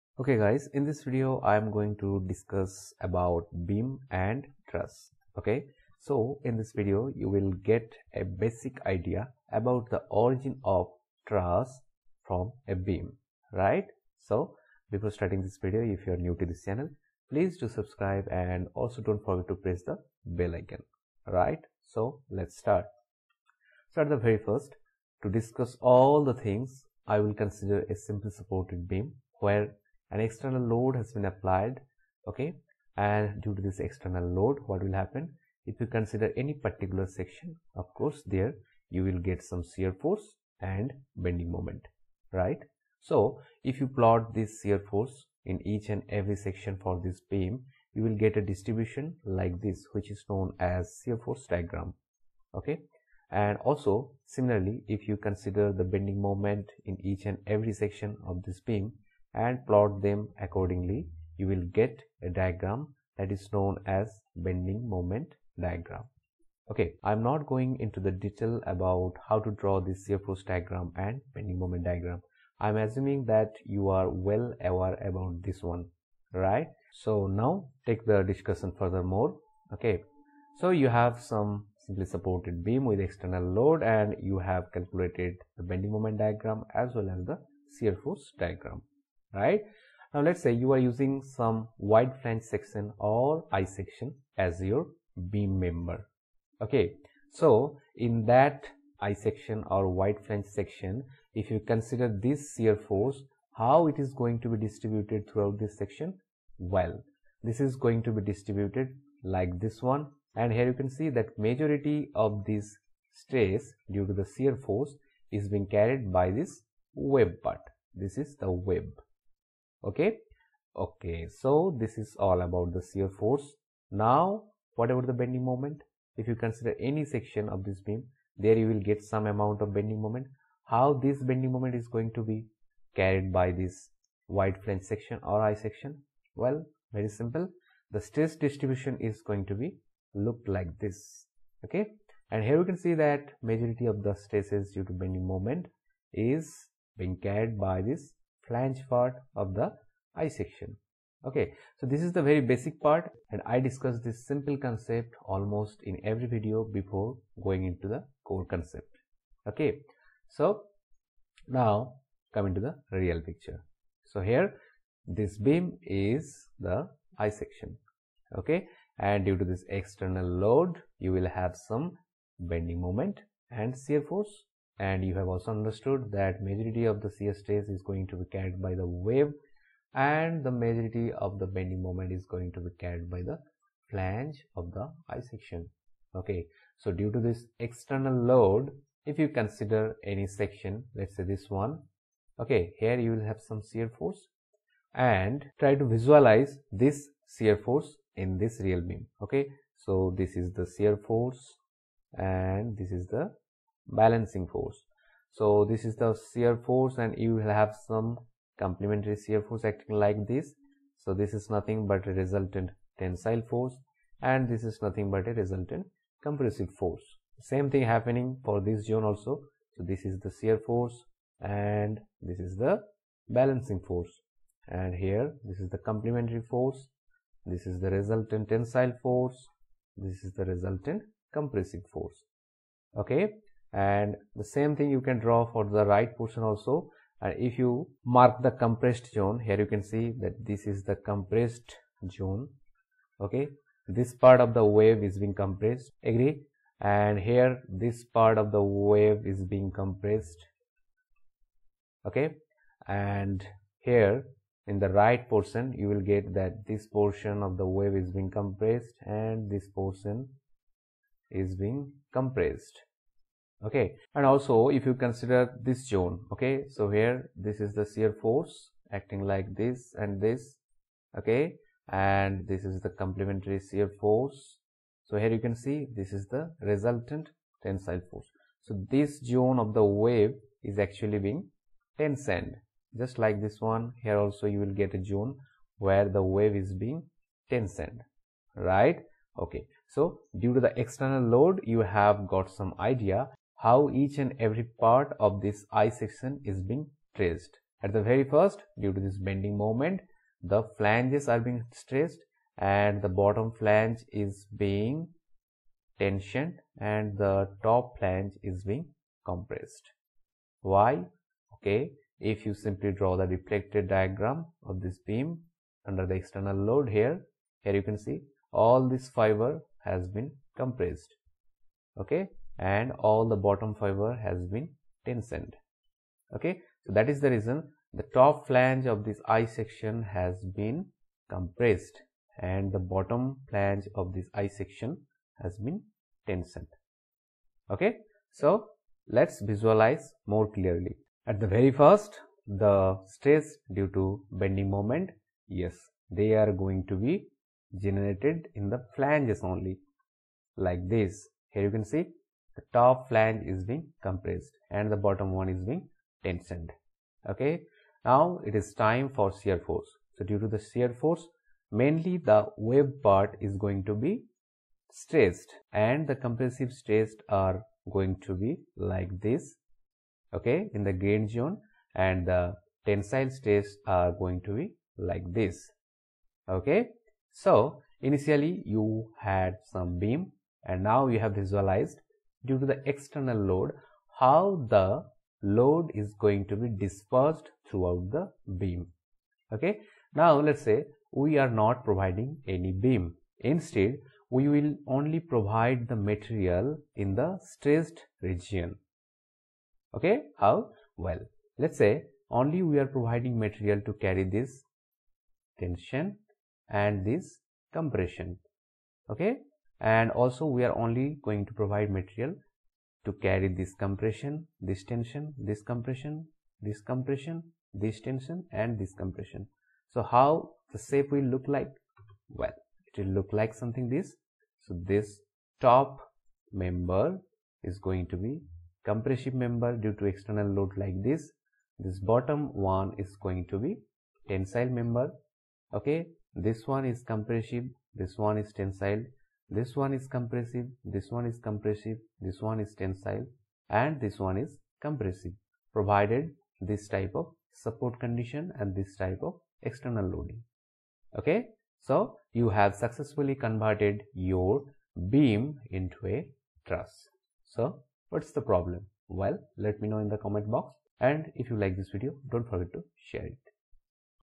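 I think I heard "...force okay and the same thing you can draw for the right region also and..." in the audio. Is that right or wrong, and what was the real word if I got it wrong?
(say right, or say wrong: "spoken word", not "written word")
wrong: "portion", not "region".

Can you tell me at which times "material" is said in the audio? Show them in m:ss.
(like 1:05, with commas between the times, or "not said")
6:35, 6:43, 6:51.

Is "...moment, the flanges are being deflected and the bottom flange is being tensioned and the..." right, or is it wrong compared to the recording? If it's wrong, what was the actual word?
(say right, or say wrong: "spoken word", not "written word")
wrong: "stressed", not "deflected".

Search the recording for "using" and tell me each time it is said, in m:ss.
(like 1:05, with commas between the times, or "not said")
1:30.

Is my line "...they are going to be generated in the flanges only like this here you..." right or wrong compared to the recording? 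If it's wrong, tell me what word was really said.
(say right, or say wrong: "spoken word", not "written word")
right.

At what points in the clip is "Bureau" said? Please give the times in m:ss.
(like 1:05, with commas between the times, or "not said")
not said.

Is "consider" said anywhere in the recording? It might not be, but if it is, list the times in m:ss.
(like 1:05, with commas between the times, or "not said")
0:27, 0:35, 0:55, 1:41, 2:06, 3:09, 4:24.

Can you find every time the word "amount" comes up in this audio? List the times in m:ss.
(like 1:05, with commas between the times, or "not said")
2:09.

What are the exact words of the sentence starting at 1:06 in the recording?
Okay, I'm not going into the detail about how to draw this shear-force diagram and bending moment diagram.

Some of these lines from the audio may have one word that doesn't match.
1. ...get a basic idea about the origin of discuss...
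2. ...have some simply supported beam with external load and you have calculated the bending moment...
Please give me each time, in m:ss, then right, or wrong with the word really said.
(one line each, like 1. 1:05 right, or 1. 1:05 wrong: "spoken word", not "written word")
1. 0:07 wrong: "truss", not "discuss"
2. 1:20 right.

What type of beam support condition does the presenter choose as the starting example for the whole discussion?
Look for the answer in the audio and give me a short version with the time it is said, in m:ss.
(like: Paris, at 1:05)
Simple supported, at 0:28.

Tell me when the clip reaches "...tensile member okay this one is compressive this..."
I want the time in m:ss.
7:14.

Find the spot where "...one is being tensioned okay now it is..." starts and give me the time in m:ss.
5:55.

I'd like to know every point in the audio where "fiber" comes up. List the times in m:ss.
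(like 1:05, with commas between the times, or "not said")
5:19, 5:23.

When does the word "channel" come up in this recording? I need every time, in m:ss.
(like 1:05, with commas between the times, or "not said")
0:16.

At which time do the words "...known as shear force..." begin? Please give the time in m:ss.
0:50.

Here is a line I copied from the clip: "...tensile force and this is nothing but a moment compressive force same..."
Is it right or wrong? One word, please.
wrong.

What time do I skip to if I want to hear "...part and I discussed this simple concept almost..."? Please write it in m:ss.
2:32.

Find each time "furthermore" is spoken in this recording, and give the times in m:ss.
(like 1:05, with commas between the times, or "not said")
1:18.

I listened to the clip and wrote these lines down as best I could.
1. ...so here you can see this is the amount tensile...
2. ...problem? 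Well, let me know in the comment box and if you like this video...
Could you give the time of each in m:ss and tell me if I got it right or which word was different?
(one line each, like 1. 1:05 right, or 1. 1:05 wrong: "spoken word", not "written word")
1. 4:35 wrong: "resultant", not "amount"
2. 7:38 right.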